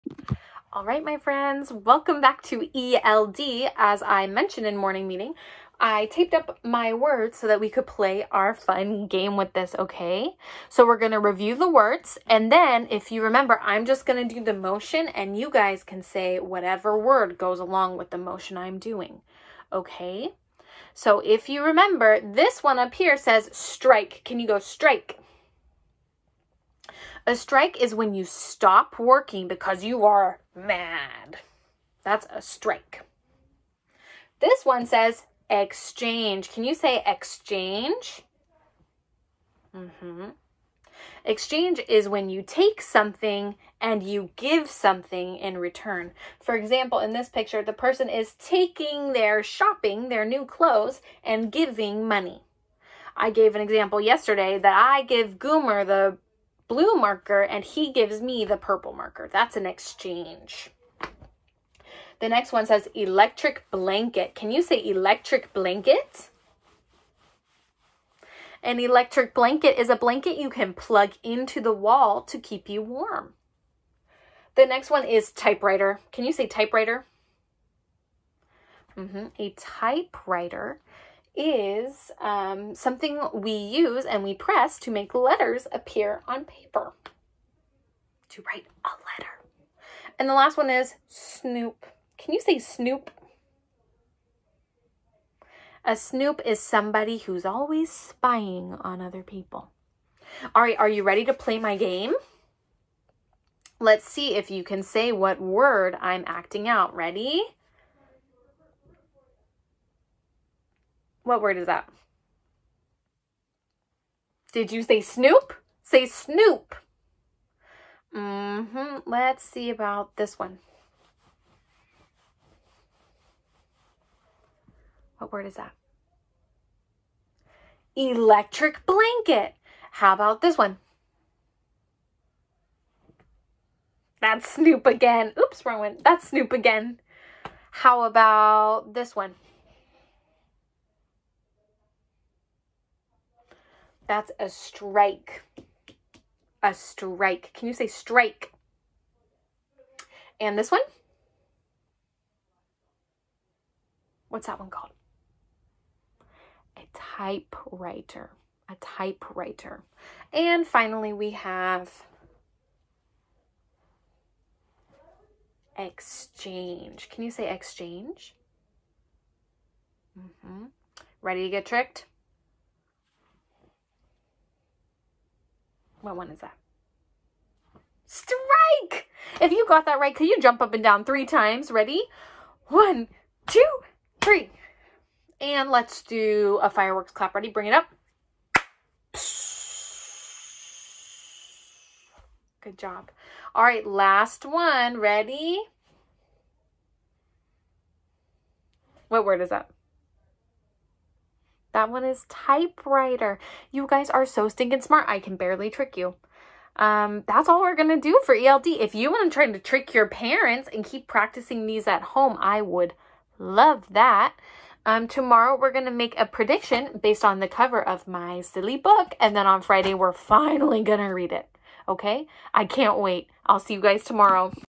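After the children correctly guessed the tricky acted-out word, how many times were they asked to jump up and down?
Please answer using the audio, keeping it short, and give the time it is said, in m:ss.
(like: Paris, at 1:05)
3, at 3:01.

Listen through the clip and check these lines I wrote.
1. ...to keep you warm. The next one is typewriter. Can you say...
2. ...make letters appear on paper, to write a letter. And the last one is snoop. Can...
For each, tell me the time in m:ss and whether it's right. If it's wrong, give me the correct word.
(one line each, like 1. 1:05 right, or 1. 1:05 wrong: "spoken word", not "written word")
1. 1:12 right
2. 1:24 right.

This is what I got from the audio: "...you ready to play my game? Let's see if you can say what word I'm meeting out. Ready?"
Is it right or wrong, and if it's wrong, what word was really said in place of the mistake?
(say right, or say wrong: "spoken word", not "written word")
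wrong: "acting", not "meeting".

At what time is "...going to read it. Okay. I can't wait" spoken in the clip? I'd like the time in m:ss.
3:40.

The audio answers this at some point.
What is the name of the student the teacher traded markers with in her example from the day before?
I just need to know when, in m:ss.
0:55.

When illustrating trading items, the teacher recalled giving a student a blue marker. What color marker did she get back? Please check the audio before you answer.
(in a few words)
purple.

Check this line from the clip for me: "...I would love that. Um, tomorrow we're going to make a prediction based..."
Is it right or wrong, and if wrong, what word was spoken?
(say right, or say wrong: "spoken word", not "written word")
right.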